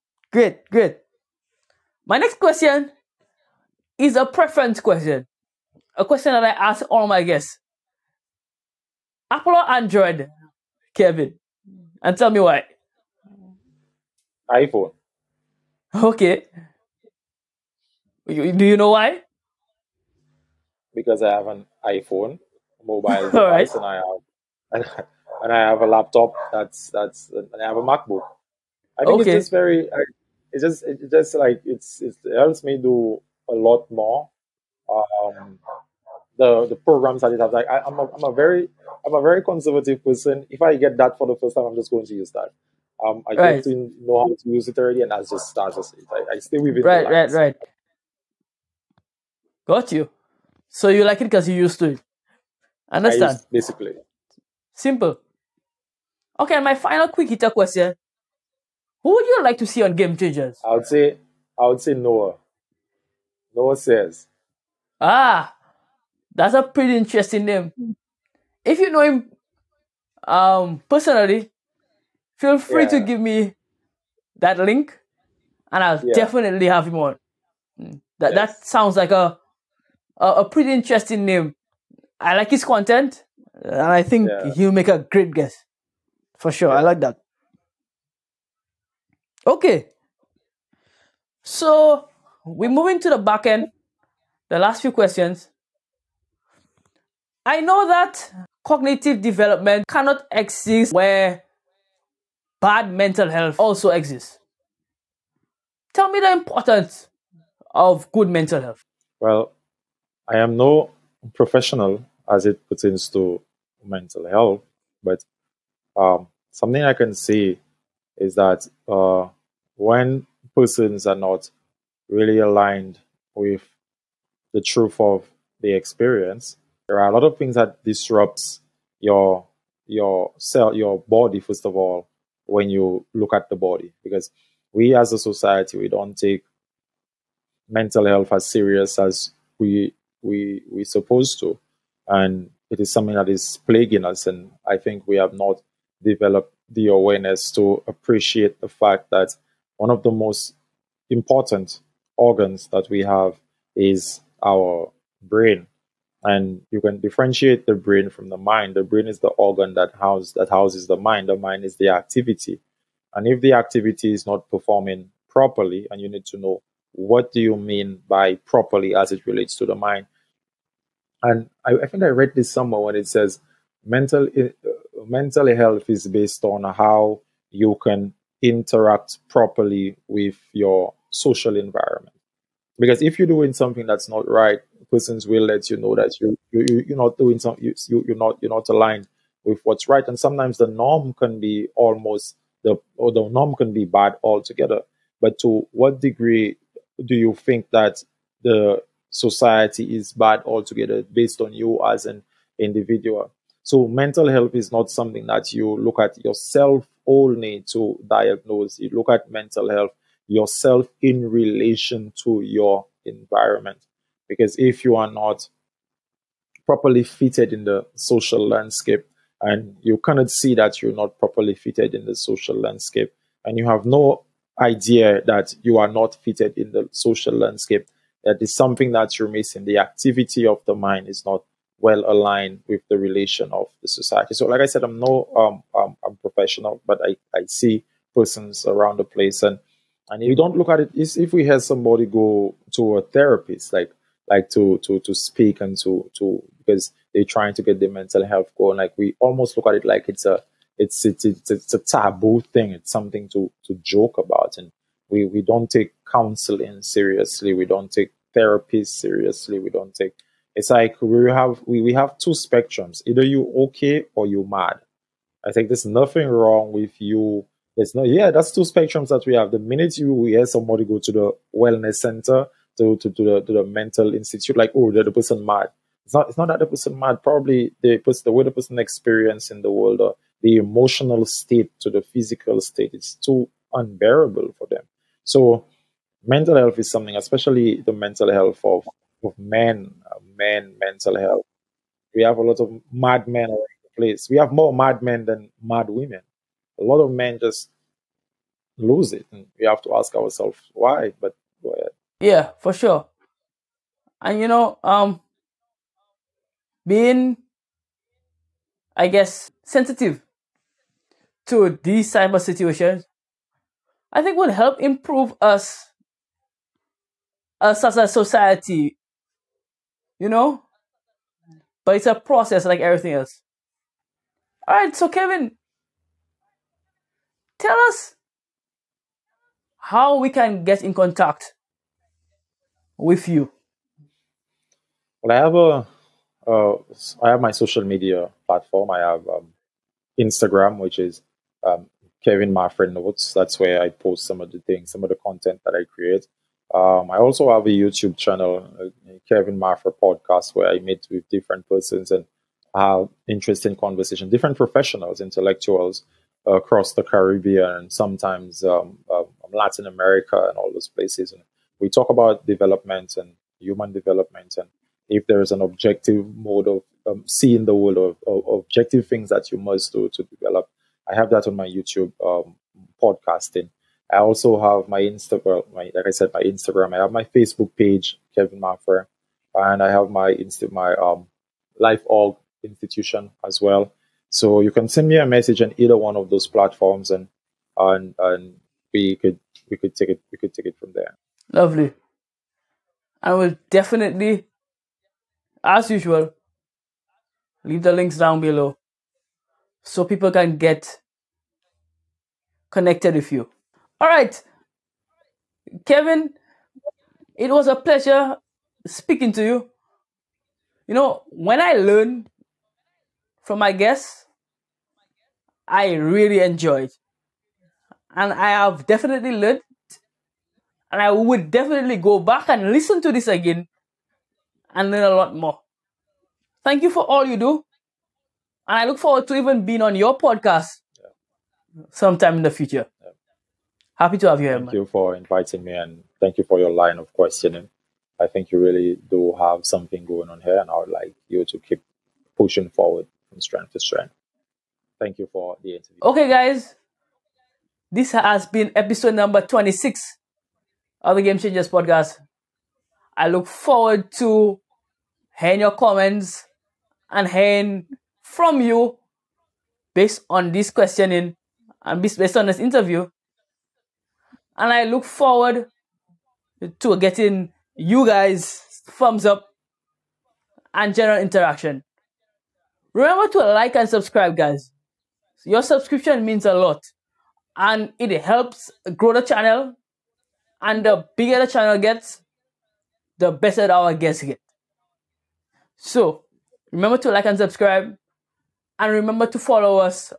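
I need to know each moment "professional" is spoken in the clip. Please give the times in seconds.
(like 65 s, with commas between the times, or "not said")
111 s, 236 s, 354 s.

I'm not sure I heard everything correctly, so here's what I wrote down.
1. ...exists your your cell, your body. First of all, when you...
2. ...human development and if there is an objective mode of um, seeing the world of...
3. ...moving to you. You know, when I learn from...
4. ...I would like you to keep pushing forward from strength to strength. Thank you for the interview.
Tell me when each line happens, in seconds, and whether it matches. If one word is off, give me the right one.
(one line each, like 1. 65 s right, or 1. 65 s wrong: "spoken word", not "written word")
1. 127 s wrong: "disrupts", not "exists"
2. 363 s right
3. 408 s wrong: "speaking", not "moving"
4. 440 s right.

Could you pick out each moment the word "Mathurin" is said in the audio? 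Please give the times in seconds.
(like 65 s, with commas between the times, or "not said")
342 s, 349 s, 378 s.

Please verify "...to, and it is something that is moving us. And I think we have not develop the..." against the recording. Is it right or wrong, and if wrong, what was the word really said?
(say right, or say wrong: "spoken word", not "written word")
wrong: "plaguing", not "moving".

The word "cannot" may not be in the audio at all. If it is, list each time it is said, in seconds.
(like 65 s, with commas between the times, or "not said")
99 s, 219 s.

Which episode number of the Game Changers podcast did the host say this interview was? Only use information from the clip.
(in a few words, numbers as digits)
26.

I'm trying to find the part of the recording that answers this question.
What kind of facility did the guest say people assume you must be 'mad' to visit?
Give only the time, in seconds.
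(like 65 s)
271 s.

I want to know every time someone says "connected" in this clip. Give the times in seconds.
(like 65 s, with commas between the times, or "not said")
402 s.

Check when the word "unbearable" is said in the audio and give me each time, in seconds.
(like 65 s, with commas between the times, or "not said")
283 s.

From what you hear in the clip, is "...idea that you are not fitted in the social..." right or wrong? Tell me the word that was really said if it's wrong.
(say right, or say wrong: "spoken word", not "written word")
right.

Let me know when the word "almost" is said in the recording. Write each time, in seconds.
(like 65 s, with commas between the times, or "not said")
191 s, 249 s.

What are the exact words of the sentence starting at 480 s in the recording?
And the bigger the channel gets, the better our guests get.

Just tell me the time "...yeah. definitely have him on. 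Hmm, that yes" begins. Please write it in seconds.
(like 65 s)
76 s.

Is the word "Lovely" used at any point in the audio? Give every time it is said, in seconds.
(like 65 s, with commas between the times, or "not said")
391 s.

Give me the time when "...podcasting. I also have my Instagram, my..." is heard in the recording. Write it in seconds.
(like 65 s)
373 s.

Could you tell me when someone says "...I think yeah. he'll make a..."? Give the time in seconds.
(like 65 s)
83 s.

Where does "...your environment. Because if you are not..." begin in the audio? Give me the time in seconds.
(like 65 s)
212 s.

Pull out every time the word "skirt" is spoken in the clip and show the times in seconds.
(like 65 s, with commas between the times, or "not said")
not said.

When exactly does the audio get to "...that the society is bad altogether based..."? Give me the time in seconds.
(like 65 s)
197 s.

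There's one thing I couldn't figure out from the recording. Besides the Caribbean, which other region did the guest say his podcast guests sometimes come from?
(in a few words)
Latin America.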